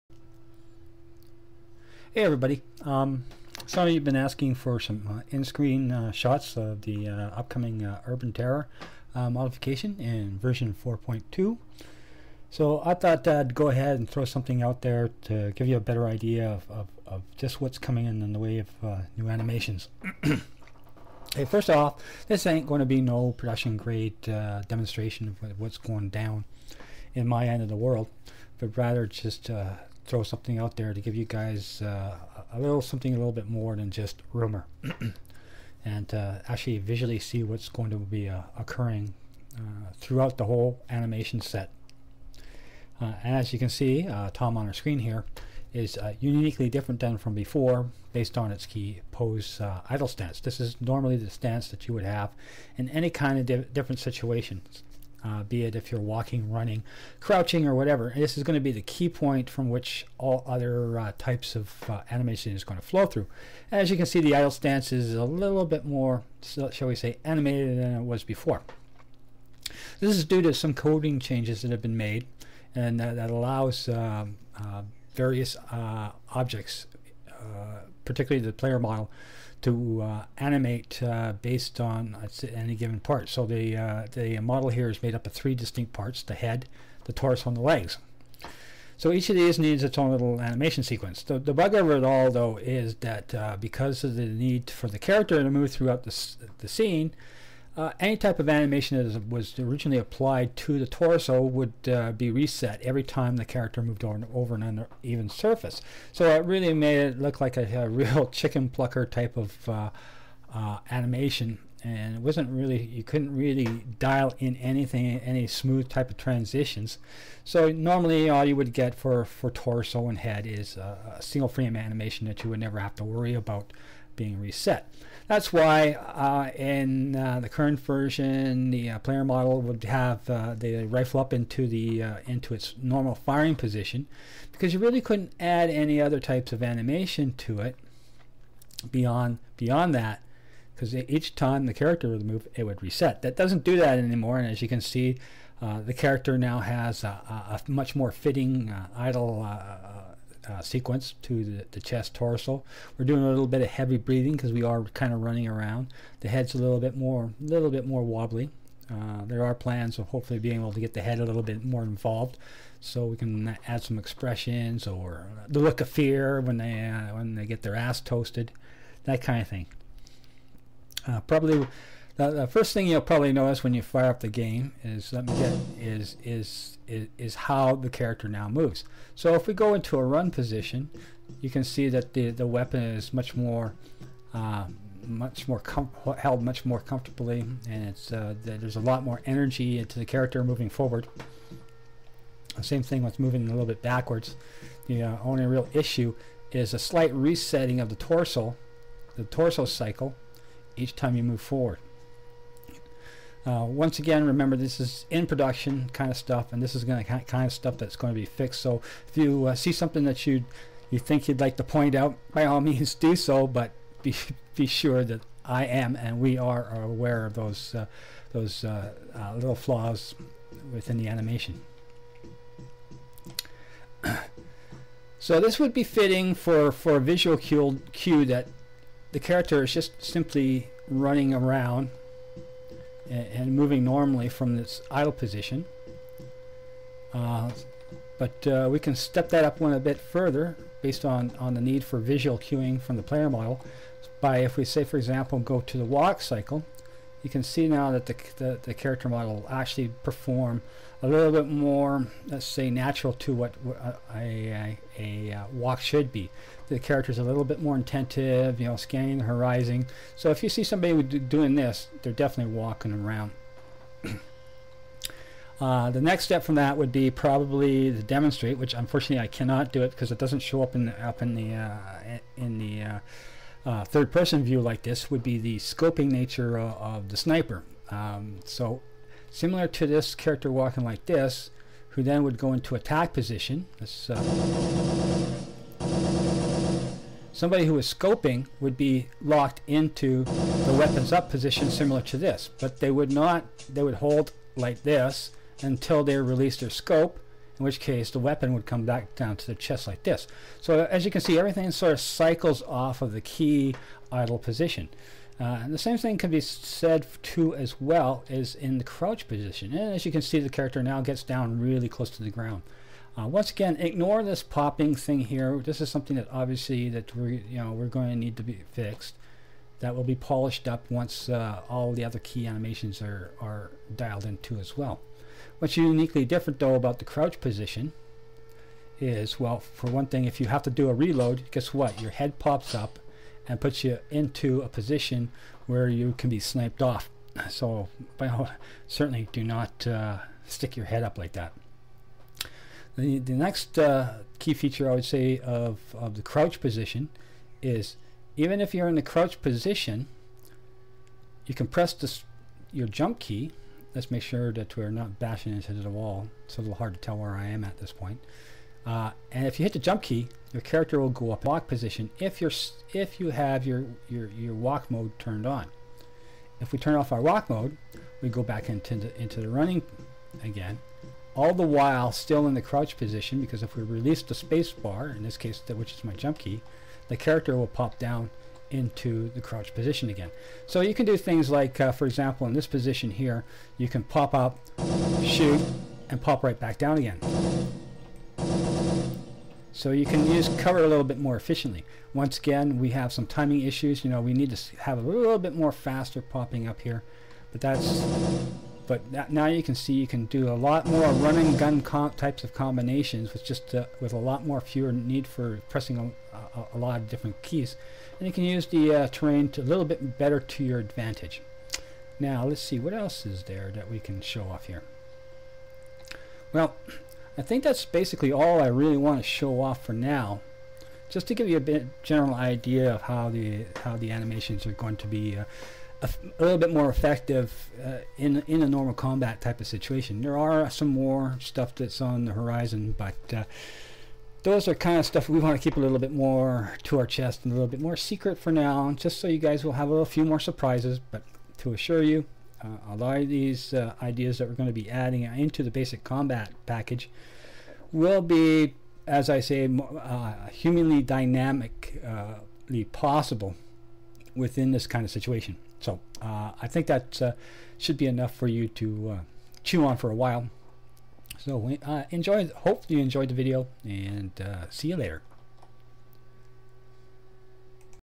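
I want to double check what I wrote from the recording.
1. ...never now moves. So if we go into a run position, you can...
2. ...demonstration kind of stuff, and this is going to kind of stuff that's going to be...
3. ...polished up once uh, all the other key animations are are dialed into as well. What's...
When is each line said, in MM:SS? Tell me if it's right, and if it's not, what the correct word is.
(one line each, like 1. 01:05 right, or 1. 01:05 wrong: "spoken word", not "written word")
1. 02:57 wrong: "character", not "never"
2. 03:25 wrong: "production", not "demonstration"
3. 05:20 right.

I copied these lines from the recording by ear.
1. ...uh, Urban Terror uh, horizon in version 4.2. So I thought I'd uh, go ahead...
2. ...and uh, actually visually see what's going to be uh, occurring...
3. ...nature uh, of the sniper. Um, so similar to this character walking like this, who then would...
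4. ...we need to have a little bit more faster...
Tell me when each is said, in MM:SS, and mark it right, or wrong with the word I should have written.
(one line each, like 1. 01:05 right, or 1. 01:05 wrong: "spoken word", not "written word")
1. 00:07 wrong: "modification", not "horizon"
2. 00:35 right
3. 04:36 right
4. 06:34 right.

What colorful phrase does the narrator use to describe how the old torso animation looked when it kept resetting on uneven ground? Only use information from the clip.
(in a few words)
chicken plucker.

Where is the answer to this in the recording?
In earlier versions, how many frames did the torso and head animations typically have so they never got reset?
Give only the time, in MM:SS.
02:01.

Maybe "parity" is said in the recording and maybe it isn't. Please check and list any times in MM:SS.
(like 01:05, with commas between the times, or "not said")
not said.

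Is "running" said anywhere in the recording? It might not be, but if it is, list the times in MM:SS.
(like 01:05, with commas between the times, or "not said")
00:56, 02:35, 03:50, 06:09.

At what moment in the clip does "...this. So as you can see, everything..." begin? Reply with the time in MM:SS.
05:00.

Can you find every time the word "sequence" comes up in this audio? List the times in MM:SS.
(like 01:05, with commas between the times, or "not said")
01:30, 02:30.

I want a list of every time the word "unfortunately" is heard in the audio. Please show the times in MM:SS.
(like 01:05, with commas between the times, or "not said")
04:28.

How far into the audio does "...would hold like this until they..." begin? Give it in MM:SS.
04:53.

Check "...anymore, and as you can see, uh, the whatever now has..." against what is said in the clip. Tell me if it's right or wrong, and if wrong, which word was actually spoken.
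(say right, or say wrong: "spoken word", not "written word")
wrong: "character", not "whatever".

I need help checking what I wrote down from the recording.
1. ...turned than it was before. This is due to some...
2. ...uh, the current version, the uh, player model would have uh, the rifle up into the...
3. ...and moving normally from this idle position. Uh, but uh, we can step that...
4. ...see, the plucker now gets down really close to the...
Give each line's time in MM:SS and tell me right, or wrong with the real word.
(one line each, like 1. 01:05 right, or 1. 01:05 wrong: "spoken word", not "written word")
1. 01:07 wrong: "animated", not "turned"
2. 02:07 right
3. 03:53 right
4. 05:10 wrong: "character", not "plucker".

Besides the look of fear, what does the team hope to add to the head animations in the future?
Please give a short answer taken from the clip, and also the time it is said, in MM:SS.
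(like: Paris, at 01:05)
expressions, at 02:43.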